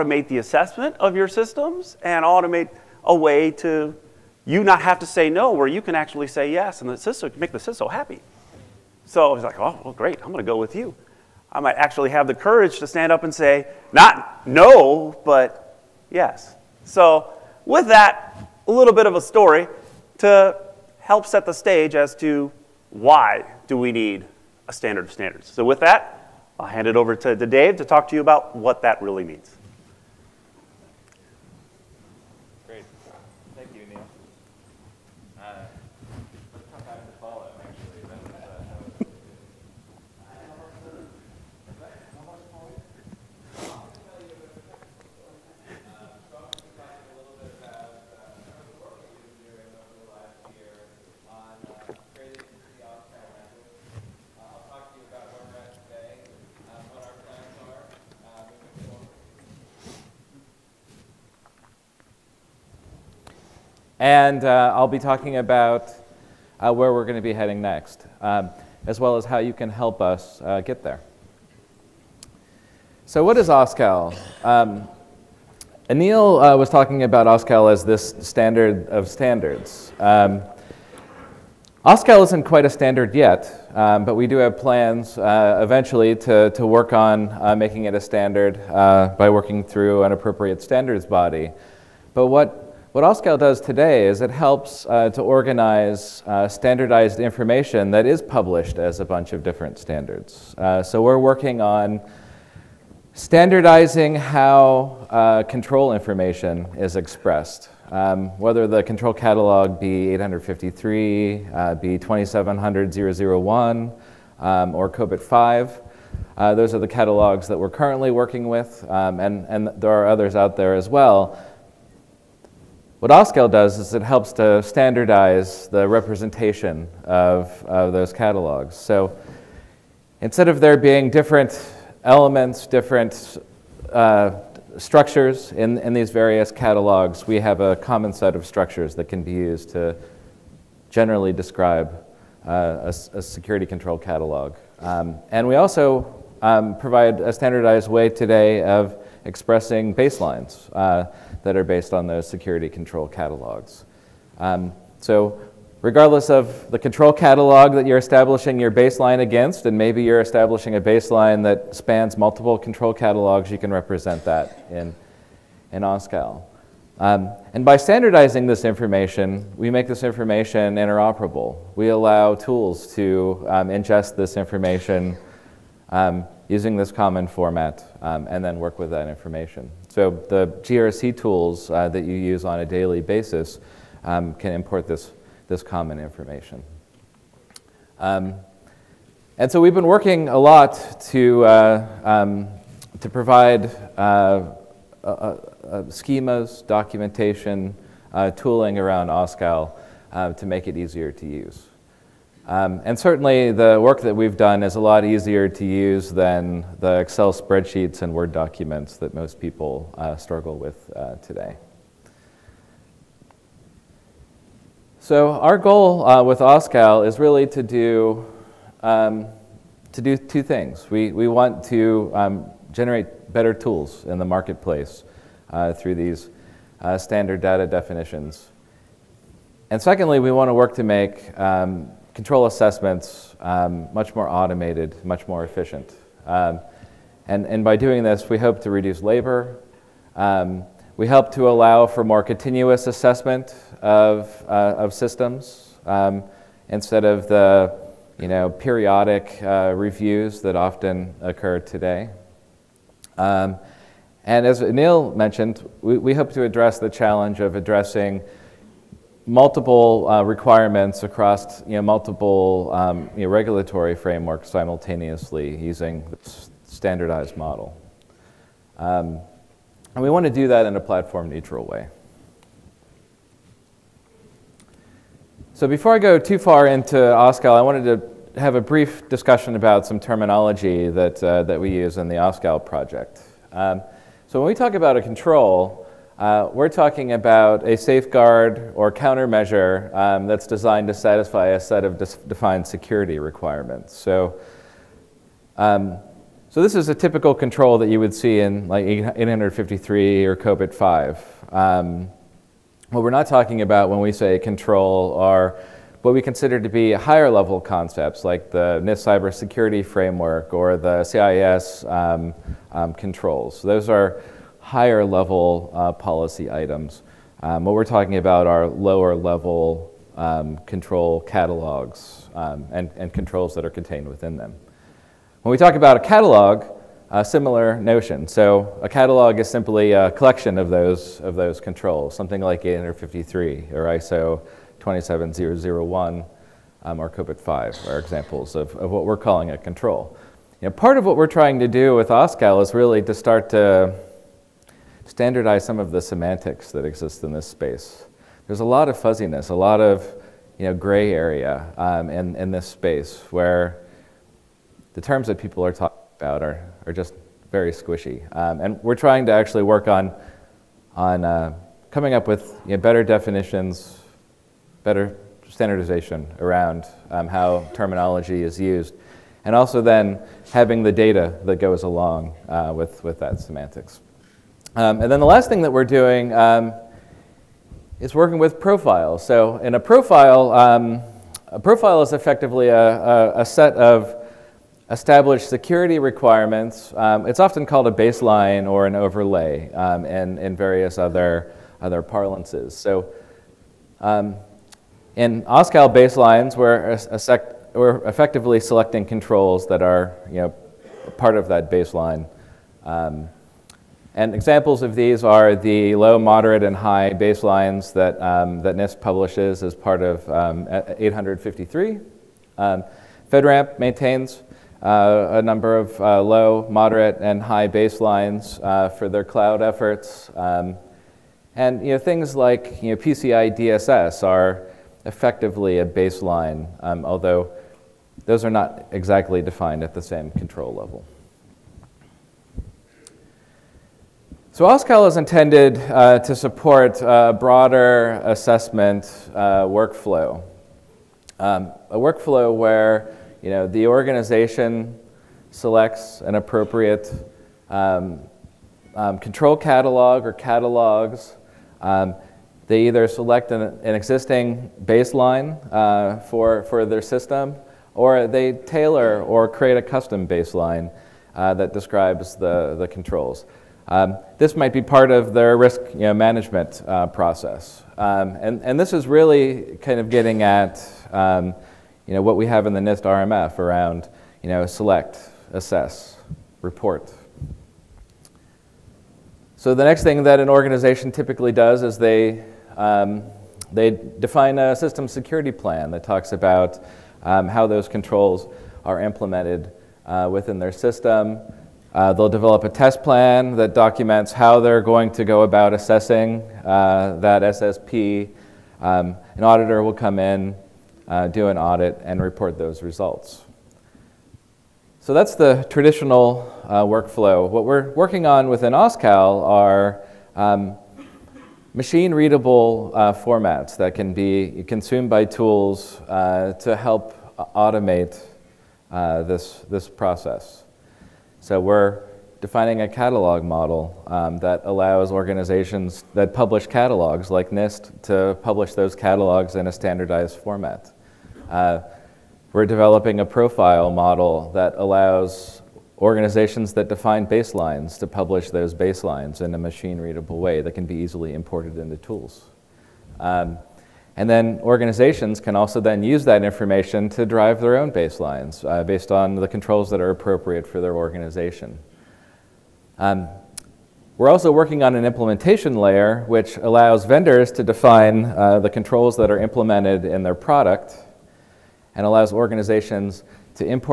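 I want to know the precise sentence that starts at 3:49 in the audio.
And secondly, we want to work to make um, control assessments um, much more automated, much more efficient.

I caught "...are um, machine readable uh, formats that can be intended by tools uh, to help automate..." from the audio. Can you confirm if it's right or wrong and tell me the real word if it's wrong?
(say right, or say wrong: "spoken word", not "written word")
wrong: "consumed", not "intended".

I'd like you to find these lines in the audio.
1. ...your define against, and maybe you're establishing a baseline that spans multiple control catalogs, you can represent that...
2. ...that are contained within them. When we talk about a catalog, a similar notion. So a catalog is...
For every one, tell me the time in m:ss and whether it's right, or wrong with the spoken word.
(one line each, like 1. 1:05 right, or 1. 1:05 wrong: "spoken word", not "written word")
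1. 2:38 wrong: "baseline", not "define"
2. 5:23 right.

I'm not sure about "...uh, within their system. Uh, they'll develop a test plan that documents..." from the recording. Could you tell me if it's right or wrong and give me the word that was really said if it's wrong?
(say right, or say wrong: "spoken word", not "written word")
right.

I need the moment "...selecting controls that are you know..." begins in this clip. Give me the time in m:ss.
6:38.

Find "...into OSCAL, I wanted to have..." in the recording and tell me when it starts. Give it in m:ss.
4:36.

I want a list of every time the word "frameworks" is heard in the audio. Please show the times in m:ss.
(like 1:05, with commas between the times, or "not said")
4:23, 5:09.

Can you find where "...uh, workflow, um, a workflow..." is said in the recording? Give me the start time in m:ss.
7:19.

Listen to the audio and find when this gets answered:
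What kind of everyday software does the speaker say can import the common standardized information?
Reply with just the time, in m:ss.
3:00.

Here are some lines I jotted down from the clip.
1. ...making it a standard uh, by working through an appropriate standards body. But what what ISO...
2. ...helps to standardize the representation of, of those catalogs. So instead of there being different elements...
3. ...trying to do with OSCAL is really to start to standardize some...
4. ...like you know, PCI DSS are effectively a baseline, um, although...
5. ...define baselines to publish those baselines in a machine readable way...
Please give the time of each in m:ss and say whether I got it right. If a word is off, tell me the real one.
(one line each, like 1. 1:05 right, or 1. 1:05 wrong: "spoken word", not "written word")
1. 1:27 wrong: "OSCAL", not "ISO"
2. 2:04 right
3. 5:41 right
4. 7:02 right
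5. 8:56 right.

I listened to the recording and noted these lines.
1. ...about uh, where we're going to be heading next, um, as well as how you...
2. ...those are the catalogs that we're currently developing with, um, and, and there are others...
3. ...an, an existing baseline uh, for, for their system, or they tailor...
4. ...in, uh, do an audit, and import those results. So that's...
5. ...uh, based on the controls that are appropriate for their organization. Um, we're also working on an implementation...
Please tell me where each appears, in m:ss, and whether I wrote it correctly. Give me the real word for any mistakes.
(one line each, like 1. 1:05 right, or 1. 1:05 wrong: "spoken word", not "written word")
1. 1:05 right
2. 1:56 wrong: "working", not "developing"
3. 7:33 right
4. 8:20 wrong: "report", not "import"
5. 9:08 right.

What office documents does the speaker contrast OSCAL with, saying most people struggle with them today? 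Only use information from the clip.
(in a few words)
Excel spreadsheets and Word documents.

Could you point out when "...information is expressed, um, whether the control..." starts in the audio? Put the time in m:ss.
1:45.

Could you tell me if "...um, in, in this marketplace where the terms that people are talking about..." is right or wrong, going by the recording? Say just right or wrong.
wrong.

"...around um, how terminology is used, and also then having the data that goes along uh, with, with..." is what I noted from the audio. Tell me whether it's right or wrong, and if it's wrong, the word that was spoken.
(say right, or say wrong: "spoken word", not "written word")
right.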